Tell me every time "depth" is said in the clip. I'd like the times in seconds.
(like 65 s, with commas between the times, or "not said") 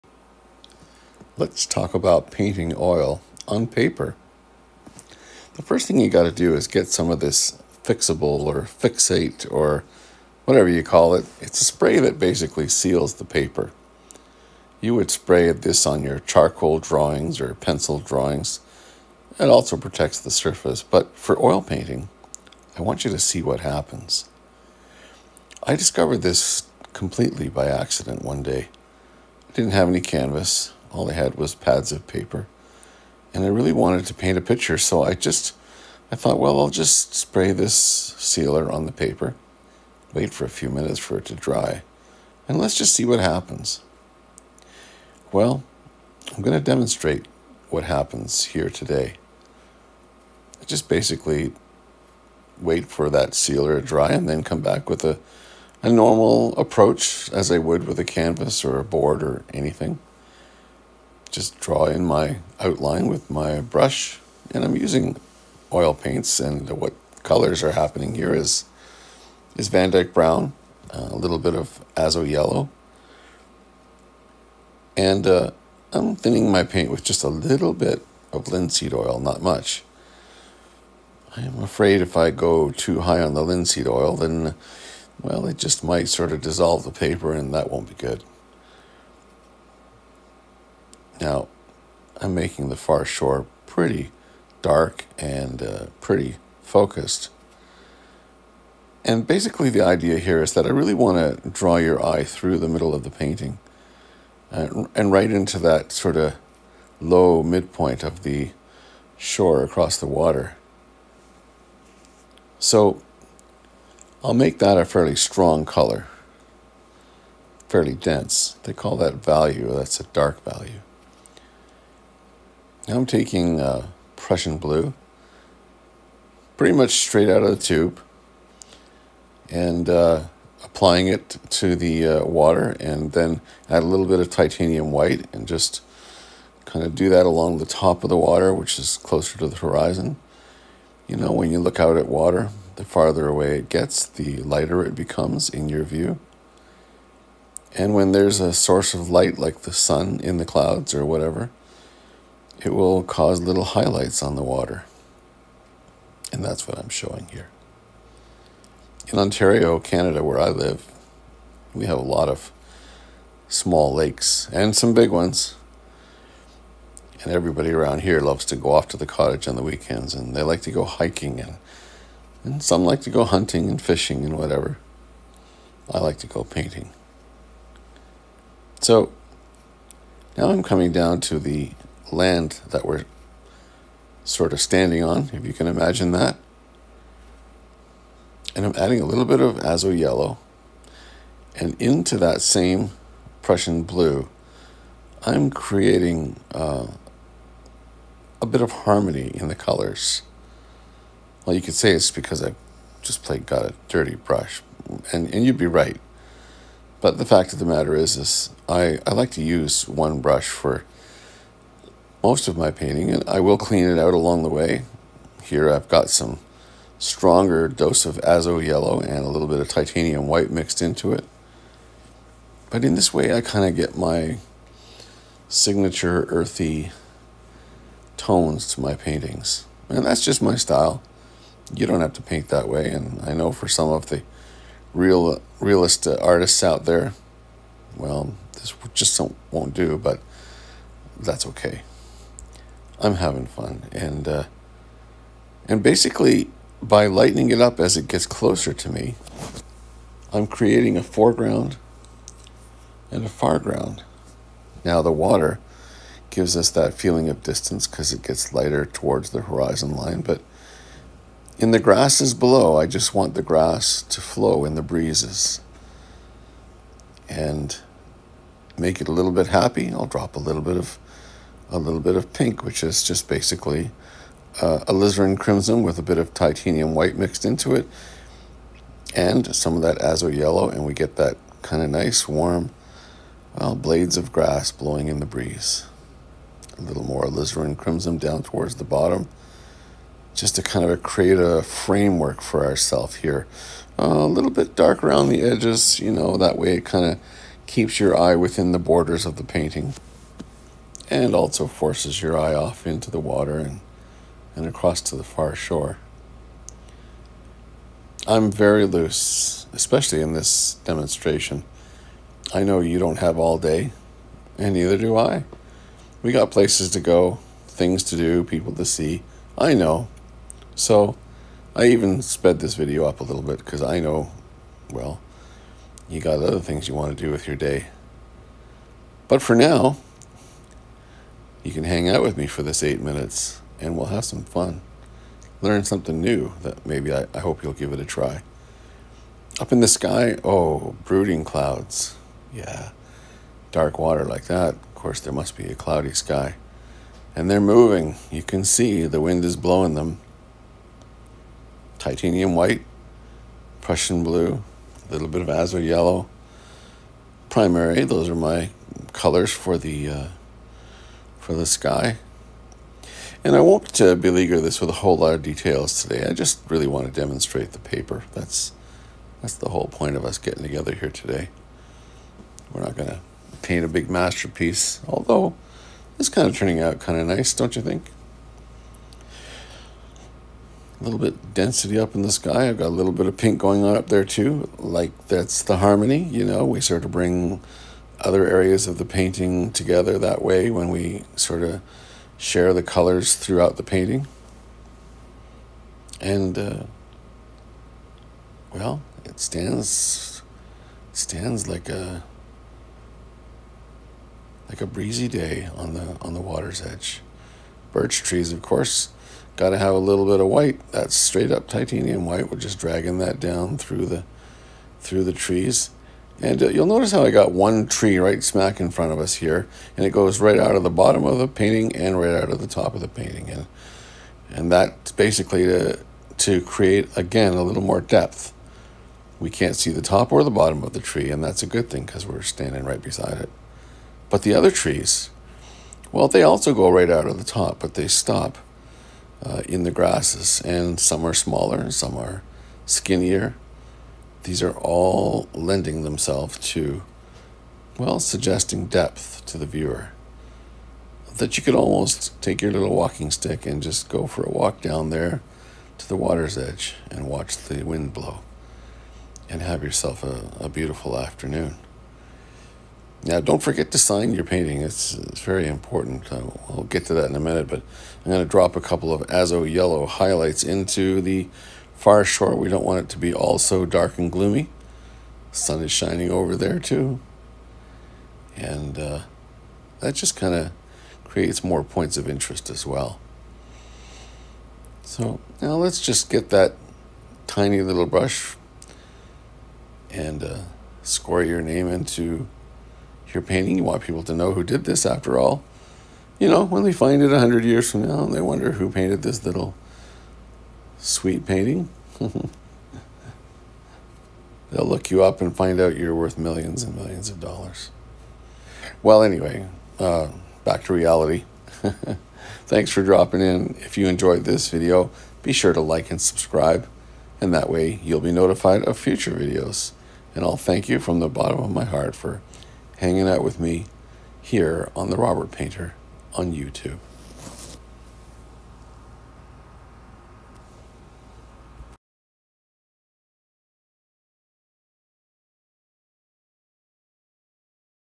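428 s, 448 s.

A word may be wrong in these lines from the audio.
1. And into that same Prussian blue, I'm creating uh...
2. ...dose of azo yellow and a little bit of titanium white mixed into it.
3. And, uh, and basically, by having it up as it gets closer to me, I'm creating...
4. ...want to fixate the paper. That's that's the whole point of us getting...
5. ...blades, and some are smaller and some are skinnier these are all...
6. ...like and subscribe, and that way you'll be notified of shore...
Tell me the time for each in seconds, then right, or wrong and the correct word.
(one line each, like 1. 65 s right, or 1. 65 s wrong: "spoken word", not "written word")
1. 191 s right
2. 217 s right
3. 243 s wrong: "lightening", not "having"
4. 366 s wrong: "demonstrate", not "fixate"
5. 439 s wrong: "grasses", not "blades"
6. 515 s wrong: "future", not "shore".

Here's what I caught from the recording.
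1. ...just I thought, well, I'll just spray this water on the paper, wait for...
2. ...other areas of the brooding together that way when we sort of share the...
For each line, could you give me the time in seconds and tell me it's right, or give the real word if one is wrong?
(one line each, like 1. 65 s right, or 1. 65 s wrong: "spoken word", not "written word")
1. 35 s wrong: "sealer", not "water"
2. 388 s wrong: "painting", not "brooding".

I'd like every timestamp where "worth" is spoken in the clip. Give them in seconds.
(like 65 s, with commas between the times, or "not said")
506 s.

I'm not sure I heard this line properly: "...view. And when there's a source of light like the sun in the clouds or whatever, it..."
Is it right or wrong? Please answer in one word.
right.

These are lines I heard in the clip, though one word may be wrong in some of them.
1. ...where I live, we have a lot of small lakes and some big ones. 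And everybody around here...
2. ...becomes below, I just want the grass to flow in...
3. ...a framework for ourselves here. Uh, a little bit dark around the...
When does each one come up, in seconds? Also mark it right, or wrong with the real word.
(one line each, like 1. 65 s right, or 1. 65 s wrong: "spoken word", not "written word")
1. 160 s right
2. 261 s wrong: "grasses", not "becomes"
3. 291 s right.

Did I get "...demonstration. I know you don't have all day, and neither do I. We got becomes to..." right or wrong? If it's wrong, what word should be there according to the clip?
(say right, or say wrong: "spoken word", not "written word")
wrong: "places", not "becomes".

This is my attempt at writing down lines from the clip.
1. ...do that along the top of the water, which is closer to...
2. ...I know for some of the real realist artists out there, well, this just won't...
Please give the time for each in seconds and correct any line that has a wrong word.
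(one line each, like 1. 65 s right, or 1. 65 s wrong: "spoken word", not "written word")
1. 136 s right
2. 233 s right.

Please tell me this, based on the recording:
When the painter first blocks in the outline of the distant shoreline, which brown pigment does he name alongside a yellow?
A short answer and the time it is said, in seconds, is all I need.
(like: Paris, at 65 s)
Van Dyke Brown, at 69 s.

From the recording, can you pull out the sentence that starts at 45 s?
Well, I'm going to demonstrate what happens here today.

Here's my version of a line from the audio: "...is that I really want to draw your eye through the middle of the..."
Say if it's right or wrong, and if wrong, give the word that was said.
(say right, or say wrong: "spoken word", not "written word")
right.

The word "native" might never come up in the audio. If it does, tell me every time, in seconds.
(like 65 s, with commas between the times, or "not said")
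not said.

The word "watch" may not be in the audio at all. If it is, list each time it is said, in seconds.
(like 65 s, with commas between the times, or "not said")
457 s.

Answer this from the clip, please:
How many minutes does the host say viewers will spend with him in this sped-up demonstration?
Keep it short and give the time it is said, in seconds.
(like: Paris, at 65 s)
8, at 332 s.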